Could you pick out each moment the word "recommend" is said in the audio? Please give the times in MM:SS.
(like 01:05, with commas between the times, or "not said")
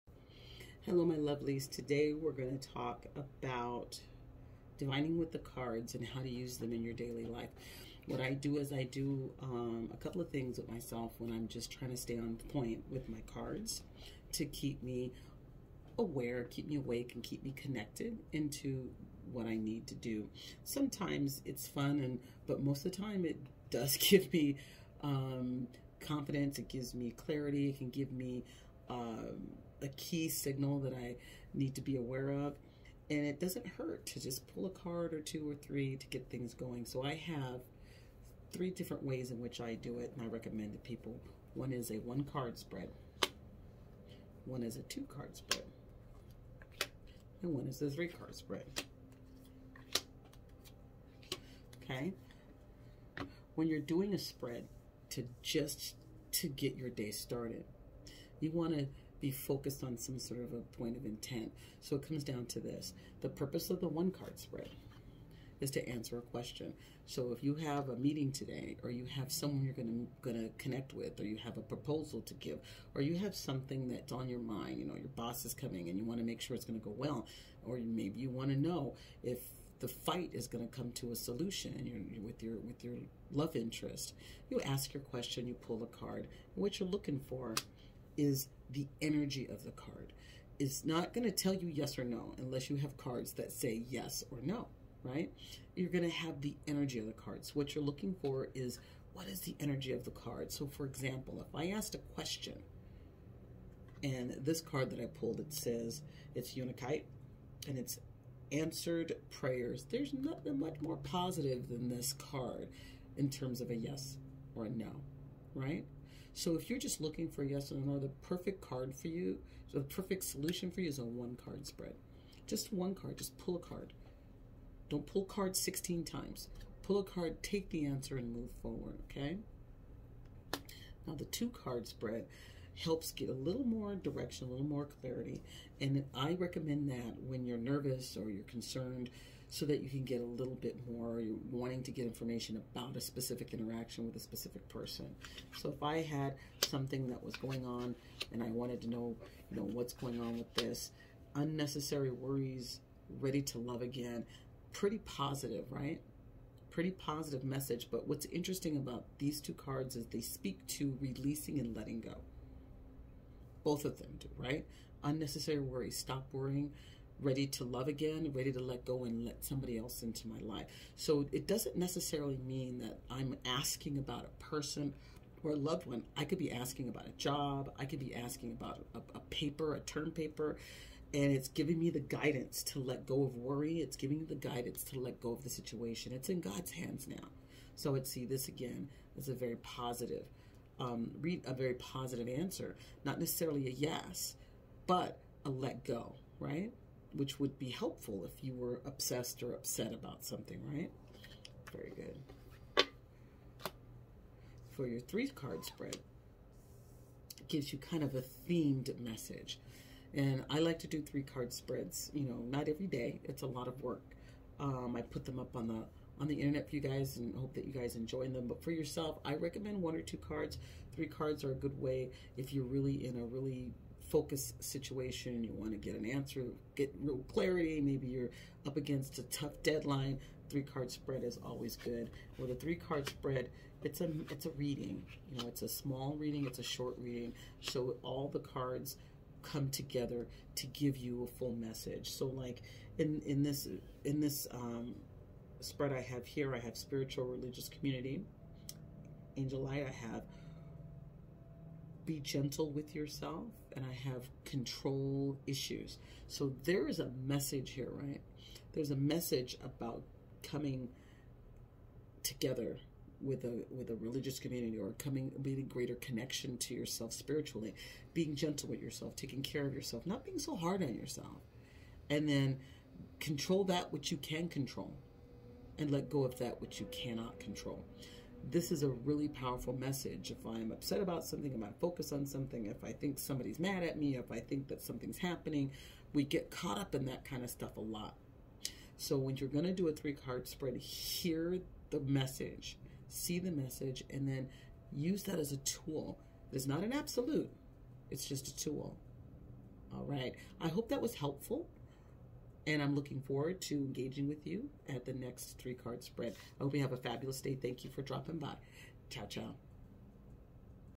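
00:40, 02:16, 03:39.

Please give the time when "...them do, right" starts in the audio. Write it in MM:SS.
02:43.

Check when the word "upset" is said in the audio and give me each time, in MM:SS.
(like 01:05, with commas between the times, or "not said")
03:19, 04:40.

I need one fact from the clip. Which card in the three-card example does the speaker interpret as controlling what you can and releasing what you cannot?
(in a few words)
Control issues.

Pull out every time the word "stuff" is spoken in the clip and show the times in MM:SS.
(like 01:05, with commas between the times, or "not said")
04:47.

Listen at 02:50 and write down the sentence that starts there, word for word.
So it doesn't necessarily mean that I'm asking about a person or a loved one.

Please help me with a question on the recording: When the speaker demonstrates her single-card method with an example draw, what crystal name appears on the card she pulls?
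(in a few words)
Unakite.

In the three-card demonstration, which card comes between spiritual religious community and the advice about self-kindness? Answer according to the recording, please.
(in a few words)
Angel light.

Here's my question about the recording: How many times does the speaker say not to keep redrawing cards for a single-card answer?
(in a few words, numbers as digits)
16.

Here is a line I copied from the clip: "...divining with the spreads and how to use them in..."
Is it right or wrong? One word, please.
wrong.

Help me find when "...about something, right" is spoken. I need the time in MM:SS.
03:19.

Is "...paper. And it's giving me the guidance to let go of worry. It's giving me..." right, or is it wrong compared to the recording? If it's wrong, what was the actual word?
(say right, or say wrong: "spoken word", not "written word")
right.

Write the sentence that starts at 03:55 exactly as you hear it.
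You know, it's a small reading, it's a short reading.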